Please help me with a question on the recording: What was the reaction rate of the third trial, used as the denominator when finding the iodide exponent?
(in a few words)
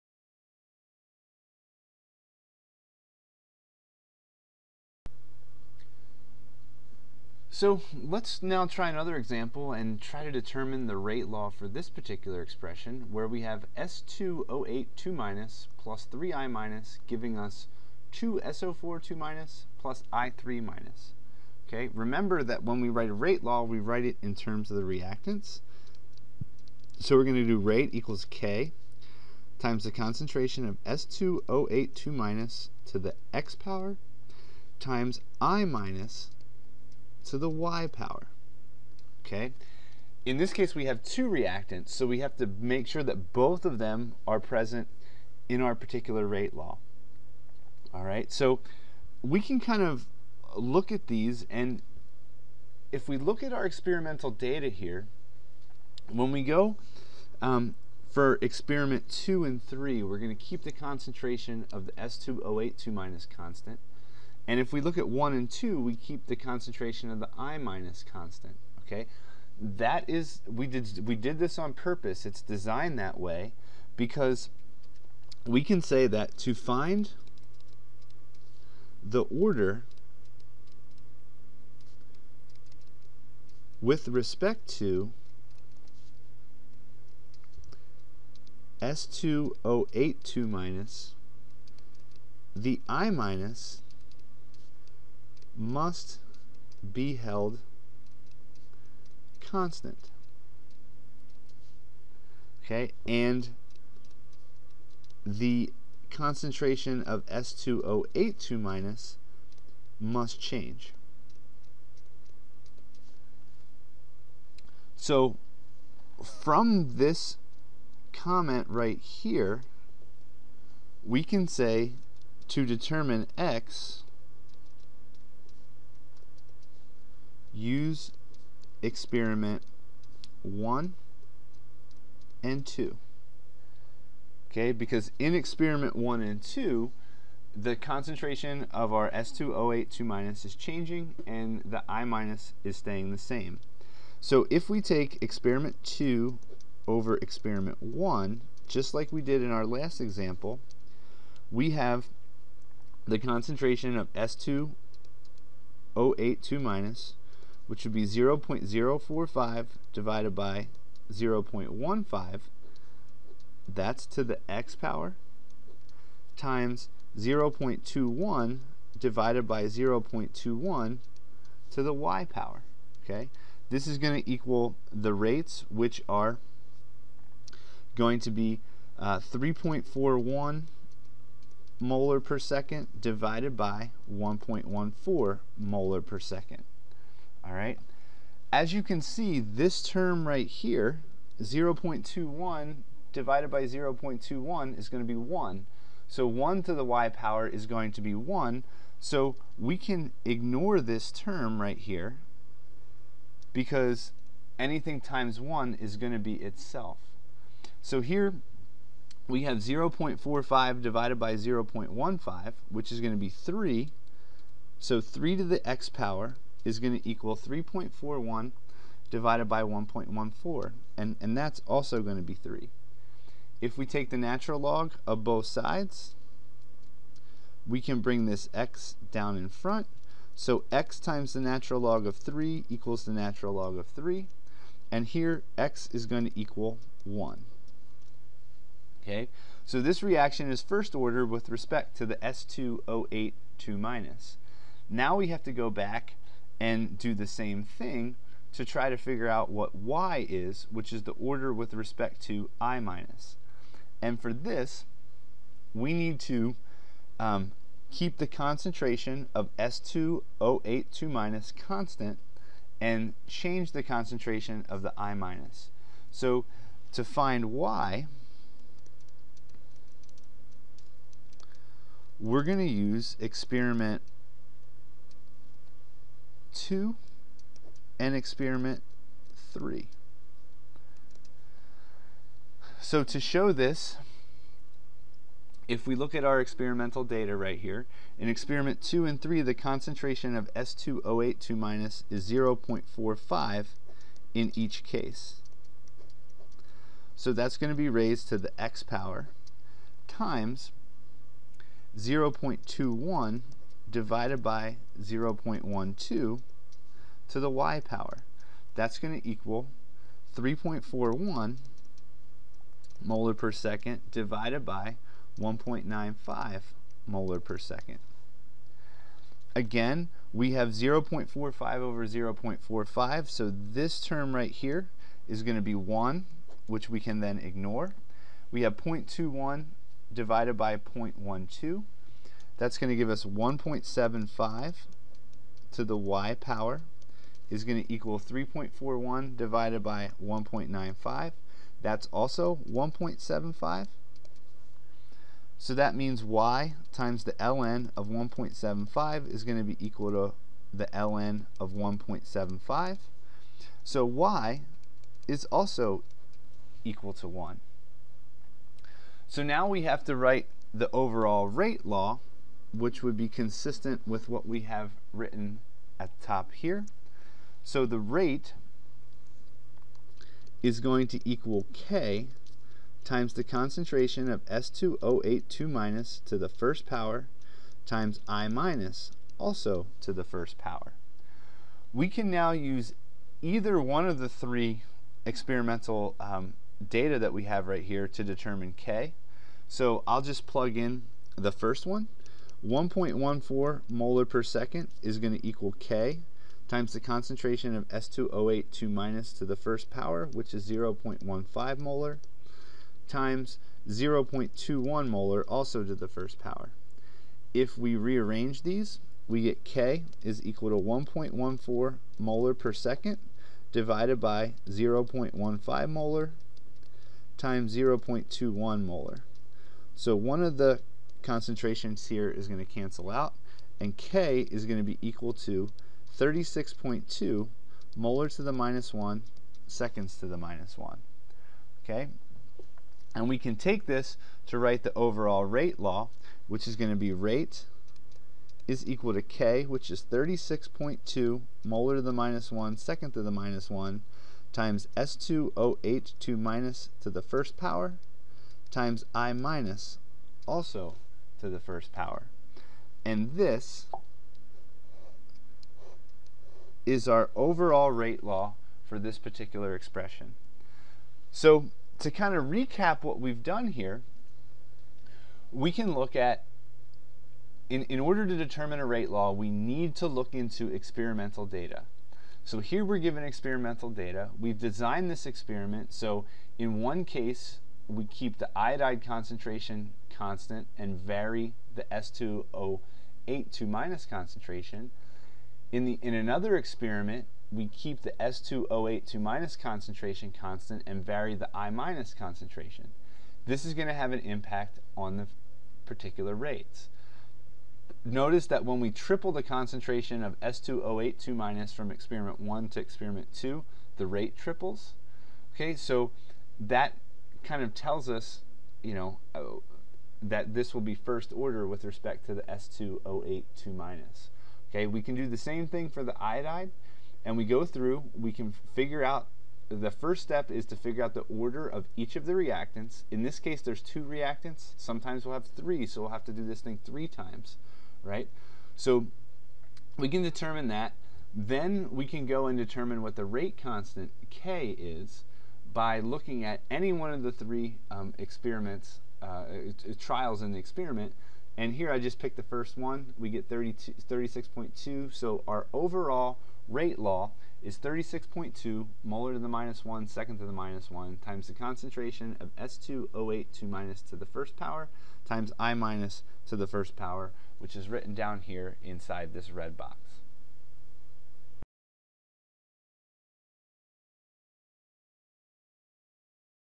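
1.95 M/s.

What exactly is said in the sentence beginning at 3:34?
So 3 to the x power is going to equal 3.41 divided by 1.14, and, and that's also going to be 3.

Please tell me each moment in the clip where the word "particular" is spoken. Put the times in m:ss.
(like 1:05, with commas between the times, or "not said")
0:11, 0:45, 7:39, 8:15.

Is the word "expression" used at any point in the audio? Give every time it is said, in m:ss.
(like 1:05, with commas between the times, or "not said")
0:12, 7:39.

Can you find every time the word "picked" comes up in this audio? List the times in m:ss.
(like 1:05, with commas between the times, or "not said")
9:02.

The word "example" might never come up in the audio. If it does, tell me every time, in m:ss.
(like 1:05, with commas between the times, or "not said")
0:09, 2:29.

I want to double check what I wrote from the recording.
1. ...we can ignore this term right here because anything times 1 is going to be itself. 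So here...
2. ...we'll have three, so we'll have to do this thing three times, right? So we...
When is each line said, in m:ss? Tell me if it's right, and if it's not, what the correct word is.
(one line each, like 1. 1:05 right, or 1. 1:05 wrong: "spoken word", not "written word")
1. 3:19 right
2. 8:45 right.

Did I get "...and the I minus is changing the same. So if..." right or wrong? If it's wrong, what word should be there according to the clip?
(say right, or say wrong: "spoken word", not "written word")
wrong: "staying", not "changing".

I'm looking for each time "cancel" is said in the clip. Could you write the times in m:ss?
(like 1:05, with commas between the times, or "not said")
7:02.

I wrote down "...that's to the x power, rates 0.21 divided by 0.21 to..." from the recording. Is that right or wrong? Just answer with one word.
wrong.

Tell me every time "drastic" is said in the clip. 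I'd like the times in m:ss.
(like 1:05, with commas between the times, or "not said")
not said.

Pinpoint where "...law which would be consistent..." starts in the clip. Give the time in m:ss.
6:01.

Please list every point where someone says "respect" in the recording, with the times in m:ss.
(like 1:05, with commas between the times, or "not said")
1:24, 4:01, 4:11, 8:31.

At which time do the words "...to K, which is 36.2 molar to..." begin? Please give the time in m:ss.
7:19.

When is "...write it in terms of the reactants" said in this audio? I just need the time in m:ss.
0:23.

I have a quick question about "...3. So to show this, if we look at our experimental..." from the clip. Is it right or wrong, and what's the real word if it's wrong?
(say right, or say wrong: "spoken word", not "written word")
right.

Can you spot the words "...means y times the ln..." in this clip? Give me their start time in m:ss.
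5:45.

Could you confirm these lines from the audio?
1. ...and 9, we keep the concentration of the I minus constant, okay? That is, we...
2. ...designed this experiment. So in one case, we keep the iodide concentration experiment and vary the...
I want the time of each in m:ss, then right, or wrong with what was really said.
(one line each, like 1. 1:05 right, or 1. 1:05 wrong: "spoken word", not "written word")
1. 1:05 wrong: "2", not "9"
2. 7:54 wrong: "constant", not "experiment".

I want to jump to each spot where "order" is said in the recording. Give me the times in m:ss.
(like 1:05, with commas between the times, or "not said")
1:19, 4:00, 4:11, 7:47, 8:31, 8:41.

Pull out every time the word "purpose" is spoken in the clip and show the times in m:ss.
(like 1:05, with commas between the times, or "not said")
1:11.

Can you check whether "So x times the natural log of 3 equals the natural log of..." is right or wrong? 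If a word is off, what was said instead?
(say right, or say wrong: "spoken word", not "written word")
right.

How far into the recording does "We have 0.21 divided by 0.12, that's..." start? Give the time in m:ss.
5:28.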